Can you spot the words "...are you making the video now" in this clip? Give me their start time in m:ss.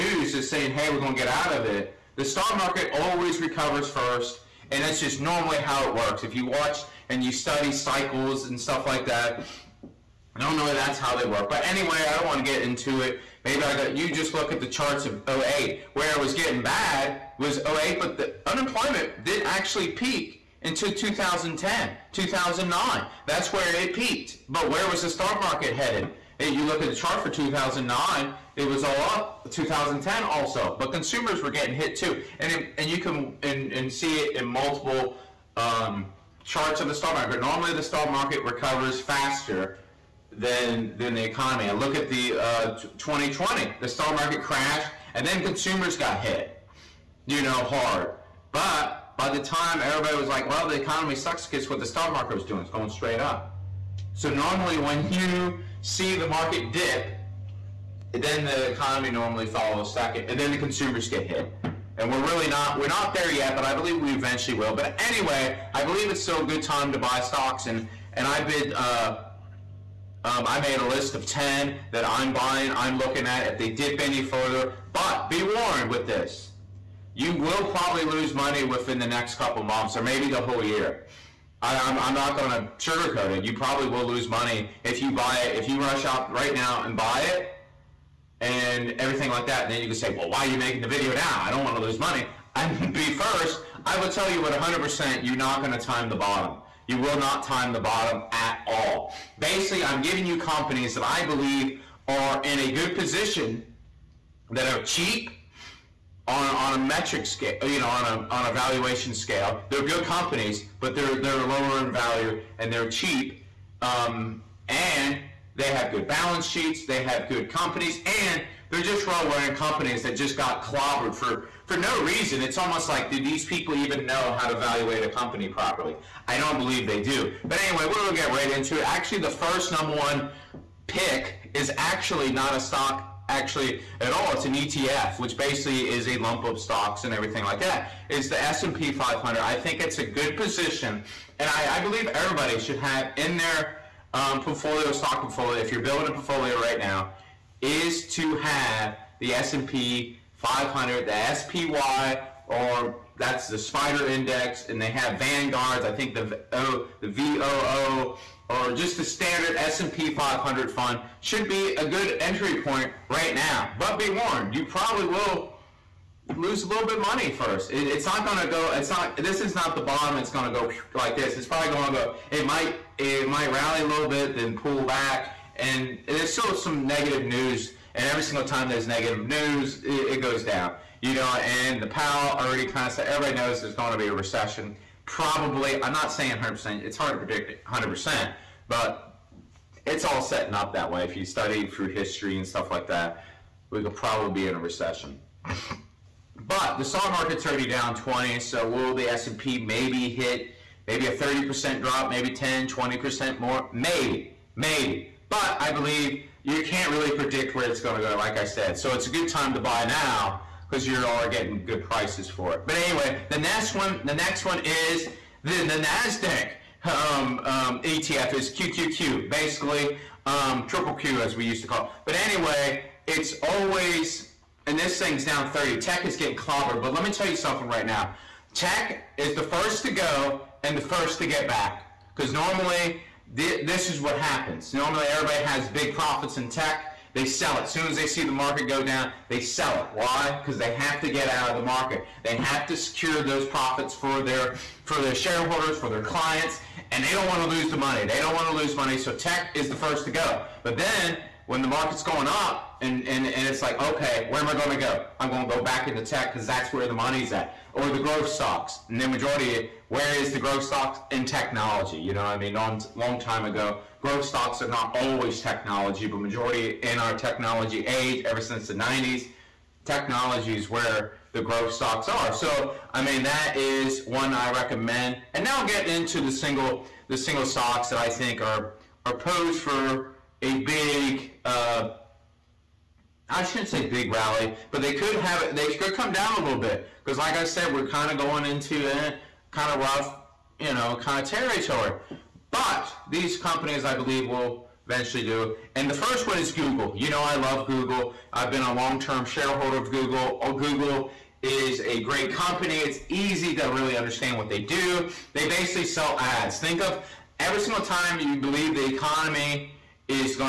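1:30.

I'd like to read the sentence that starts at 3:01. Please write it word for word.
You know, and the Powell already kind of said, everybody knows there's going to be a recession.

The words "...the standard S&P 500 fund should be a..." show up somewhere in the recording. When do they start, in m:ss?
2:38.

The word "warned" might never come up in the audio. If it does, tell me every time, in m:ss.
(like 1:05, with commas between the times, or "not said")
1:15, 2:44.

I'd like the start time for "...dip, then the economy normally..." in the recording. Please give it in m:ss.
0:56.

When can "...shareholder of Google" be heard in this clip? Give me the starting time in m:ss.
4:59.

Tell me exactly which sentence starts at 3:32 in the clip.
But anyway, the next one, the next one is the, the NASDAQ.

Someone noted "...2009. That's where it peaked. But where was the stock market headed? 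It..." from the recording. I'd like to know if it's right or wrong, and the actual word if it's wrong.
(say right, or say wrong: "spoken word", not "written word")
right.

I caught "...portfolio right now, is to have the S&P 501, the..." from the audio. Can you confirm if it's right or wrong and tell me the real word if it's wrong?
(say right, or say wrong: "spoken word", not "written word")
wrong: "500", not "501".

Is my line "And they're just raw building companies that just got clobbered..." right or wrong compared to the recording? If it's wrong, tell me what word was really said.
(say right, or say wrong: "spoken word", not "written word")
wrong: "running", not "building".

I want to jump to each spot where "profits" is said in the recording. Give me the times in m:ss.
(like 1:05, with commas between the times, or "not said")
3:55, 4:03.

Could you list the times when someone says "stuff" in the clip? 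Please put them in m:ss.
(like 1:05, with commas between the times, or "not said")
0:08, 3:12.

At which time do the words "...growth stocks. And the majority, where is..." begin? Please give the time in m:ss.
4:17.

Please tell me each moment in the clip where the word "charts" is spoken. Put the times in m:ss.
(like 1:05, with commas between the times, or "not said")
0:14, 0:26, 0:36.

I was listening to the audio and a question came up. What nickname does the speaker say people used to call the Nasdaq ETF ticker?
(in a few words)
triple Q.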